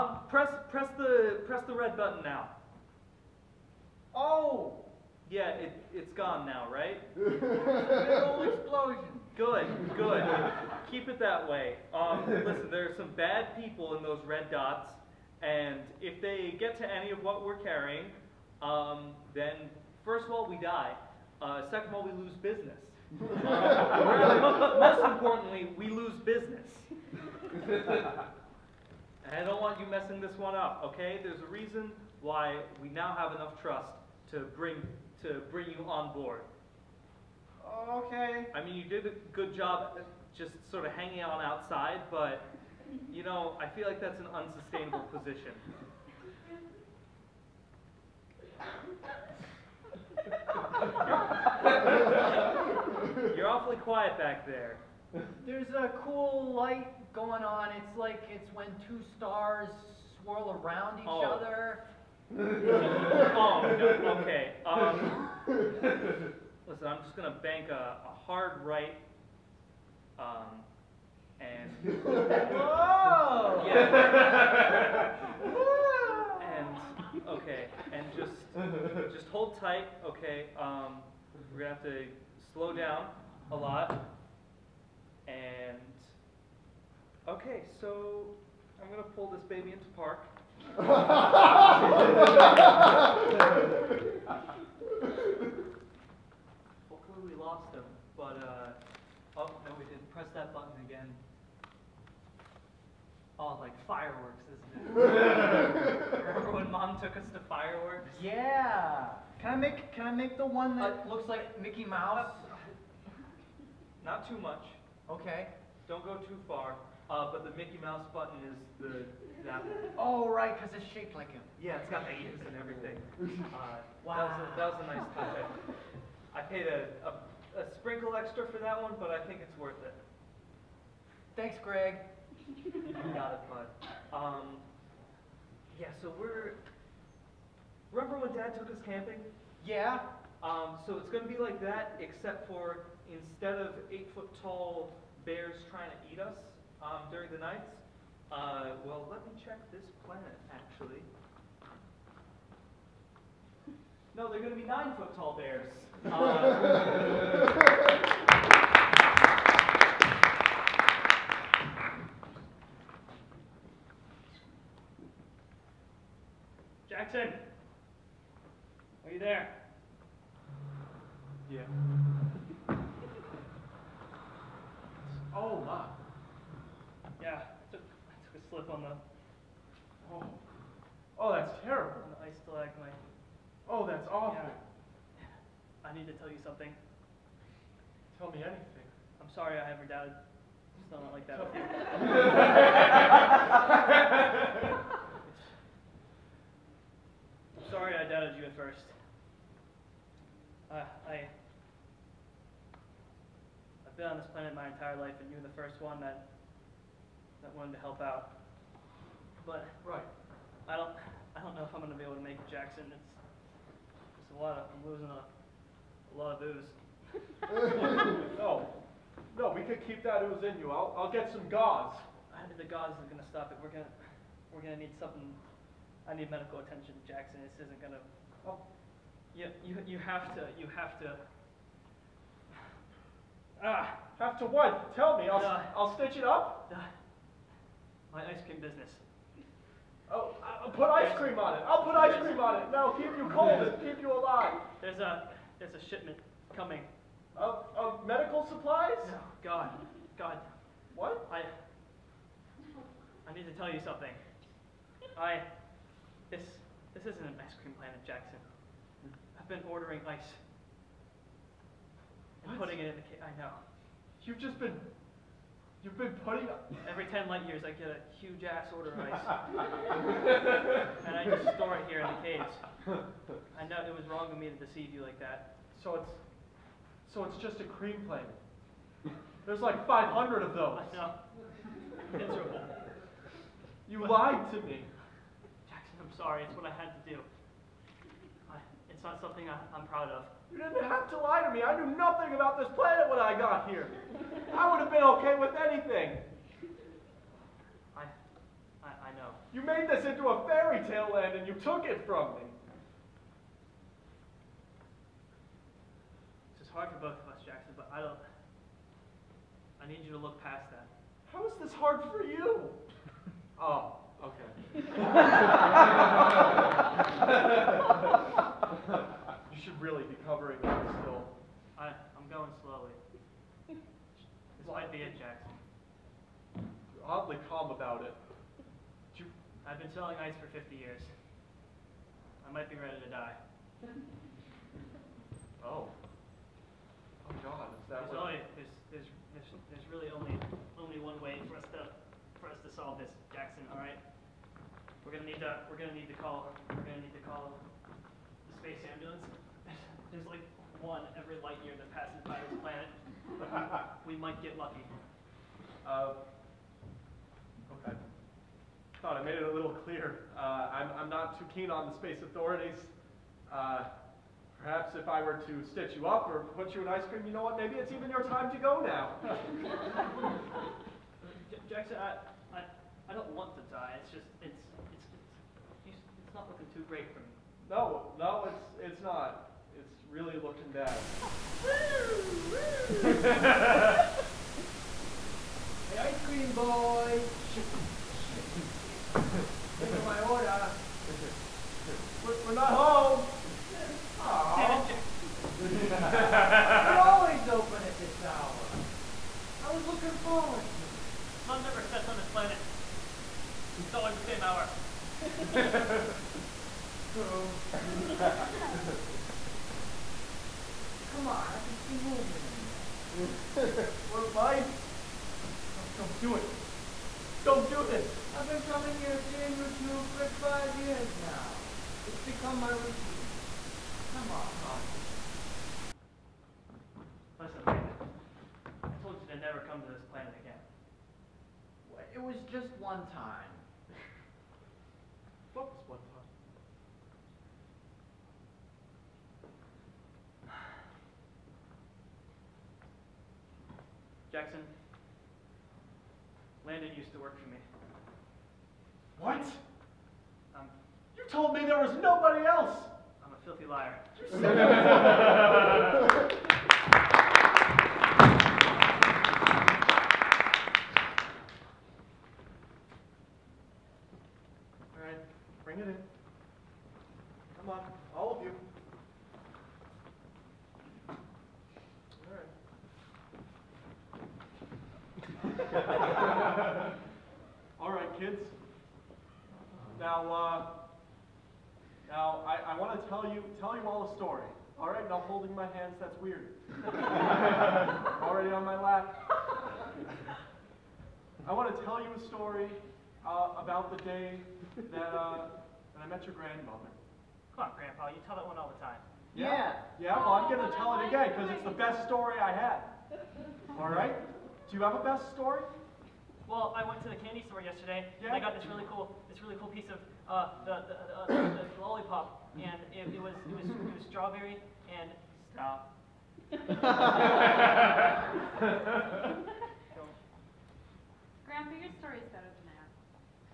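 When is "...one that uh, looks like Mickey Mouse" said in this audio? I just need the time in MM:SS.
01:50.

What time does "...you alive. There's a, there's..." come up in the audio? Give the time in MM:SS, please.
04:04.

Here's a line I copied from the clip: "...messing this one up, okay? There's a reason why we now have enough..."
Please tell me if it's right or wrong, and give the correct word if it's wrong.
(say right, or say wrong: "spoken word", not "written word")
right.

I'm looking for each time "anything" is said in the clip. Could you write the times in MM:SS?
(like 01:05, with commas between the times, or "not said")
03:08, 04:55.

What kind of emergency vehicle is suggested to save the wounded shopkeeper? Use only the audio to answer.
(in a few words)
Space ambulance.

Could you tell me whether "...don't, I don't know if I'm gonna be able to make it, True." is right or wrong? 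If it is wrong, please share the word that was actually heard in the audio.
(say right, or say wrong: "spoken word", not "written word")
wrong: "Jackson", not "True".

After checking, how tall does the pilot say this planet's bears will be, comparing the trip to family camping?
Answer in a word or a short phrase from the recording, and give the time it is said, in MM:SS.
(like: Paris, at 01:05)
9 feet, at 02:34.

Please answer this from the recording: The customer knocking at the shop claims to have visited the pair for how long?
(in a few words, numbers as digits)
5 years.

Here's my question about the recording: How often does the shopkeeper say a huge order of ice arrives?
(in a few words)
Every 10 light years.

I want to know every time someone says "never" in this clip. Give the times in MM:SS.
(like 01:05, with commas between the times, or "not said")
06:41, 07:09.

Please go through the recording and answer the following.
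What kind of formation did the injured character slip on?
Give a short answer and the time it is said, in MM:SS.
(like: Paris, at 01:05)
Ice stalagmite, at 03:02.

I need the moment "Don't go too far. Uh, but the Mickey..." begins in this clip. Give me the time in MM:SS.
01:55.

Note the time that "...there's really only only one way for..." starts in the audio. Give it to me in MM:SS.
05:39.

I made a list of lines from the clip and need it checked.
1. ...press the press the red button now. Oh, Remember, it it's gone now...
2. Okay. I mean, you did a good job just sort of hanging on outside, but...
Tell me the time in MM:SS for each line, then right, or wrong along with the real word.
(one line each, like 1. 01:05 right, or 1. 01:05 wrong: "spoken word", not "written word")
1. 00:00 wrong: "Yeah", not "Remember"
2. 00:37 right.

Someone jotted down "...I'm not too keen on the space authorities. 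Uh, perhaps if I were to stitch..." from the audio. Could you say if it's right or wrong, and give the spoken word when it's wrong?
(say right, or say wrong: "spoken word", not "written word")
right.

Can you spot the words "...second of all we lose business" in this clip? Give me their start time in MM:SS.
00:21.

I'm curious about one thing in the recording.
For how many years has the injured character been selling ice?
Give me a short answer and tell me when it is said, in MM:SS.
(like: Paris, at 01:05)
50, at 05:30.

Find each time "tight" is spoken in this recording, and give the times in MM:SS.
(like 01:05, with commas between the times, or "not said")
01:19.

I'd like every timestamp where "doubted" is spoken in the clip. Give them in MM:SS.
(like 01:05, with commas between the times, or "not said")
03:09, 03:18.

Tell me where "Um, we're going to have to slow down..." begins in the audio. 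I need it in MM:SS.
01:20.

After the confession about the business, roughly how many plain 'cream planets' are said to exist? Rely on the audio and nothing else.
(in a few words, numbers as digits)
500.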